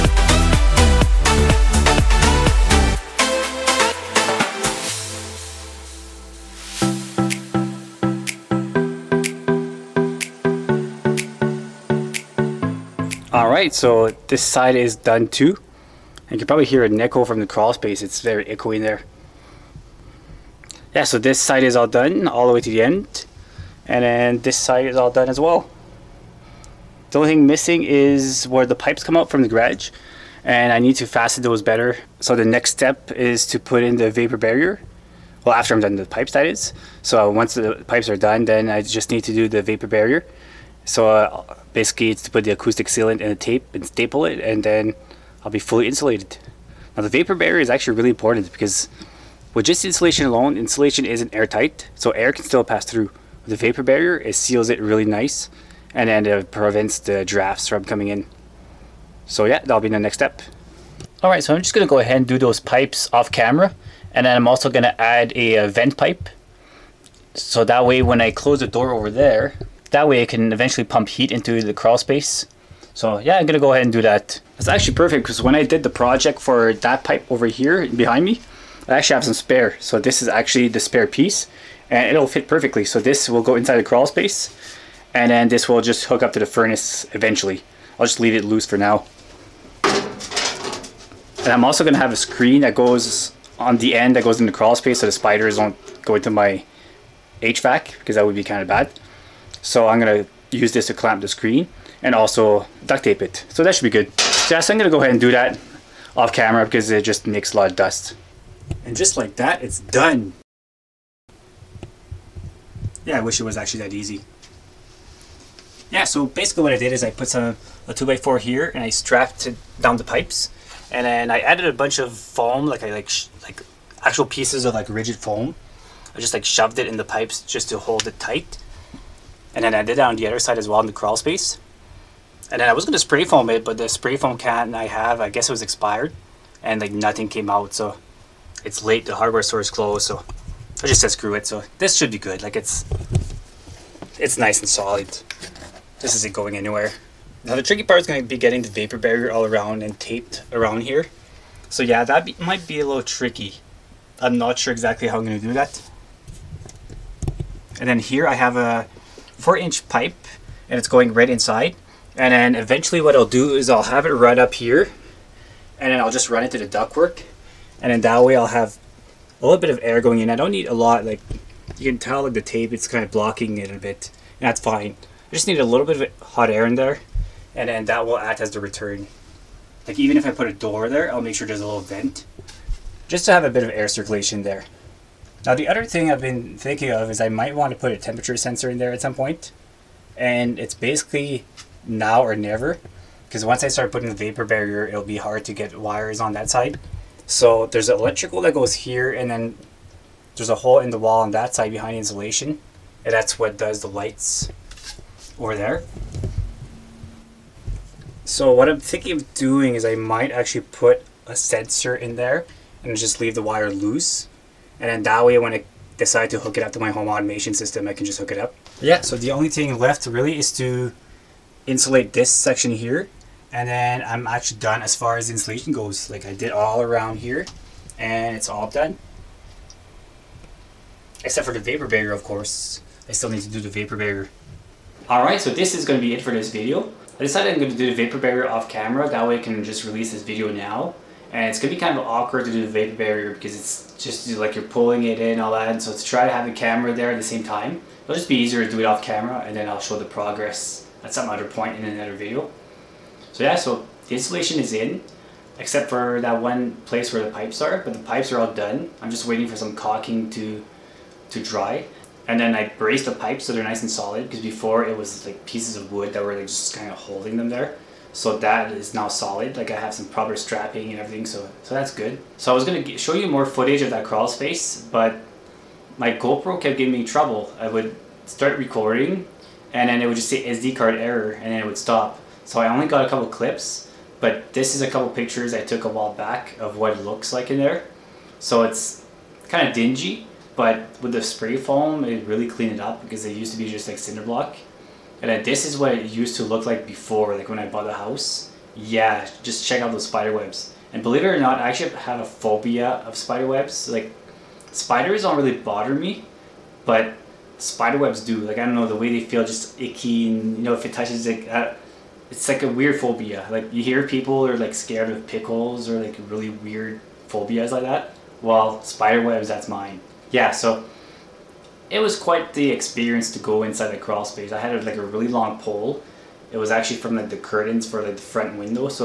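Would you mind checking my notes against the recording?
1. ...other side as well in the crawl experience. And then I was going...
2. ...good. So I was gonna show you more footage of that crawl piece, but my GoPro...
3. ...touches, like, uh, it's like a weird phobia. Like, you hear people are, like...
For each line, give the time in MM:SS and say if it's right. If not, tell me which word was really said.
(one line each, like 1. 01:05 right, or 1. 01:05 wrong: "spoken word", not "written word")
1. 02:10 wrong: "space", not "experience"
2. 04:31 wrong: "space", not "piece"
3. 05:10 right.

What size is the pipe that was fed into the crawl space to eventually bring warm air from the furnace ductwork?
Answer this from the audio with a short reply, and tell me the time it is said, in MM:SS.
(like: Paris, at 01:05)
4 inch, at 02:39.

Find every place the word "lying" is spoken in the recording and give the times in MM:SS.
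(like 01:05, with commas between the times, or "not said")
not said.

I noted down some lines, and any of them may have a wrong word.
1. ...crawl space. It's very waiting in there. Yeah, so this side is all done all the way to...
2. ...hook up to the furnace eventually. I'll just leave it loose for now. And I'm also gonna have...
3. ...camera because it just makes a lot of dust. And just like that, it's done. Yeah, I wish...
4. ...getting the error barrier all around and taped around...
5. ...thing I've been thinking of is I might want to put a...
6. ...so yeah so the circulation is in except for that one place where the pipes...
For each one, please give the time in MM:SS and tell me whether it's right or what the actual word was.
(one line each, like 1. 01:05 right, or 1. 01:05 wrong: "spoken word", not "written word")
1. 00:17 wrong: "echoing", not "waiting"
2. 01:26 right
3. 01:46 right
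4. 02:28 wrong: "vapor", not "error"
5. 03:05 right
6. 04:13 wrong: "installation", not "circulation".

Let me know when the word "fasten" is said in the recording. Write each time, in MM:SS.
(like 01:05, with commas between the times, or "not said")
00:31.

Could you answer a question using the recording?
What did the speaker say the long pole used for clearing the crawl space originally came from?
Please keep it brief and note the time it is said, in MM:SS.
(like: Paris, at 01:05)
the curtains, at 05:27.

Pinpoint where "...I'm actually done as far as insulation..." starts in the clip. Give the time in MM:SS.
03:44.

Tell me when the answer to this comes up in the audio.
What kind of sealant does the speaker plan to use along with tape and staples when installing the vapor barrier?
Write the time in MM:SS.
00:42.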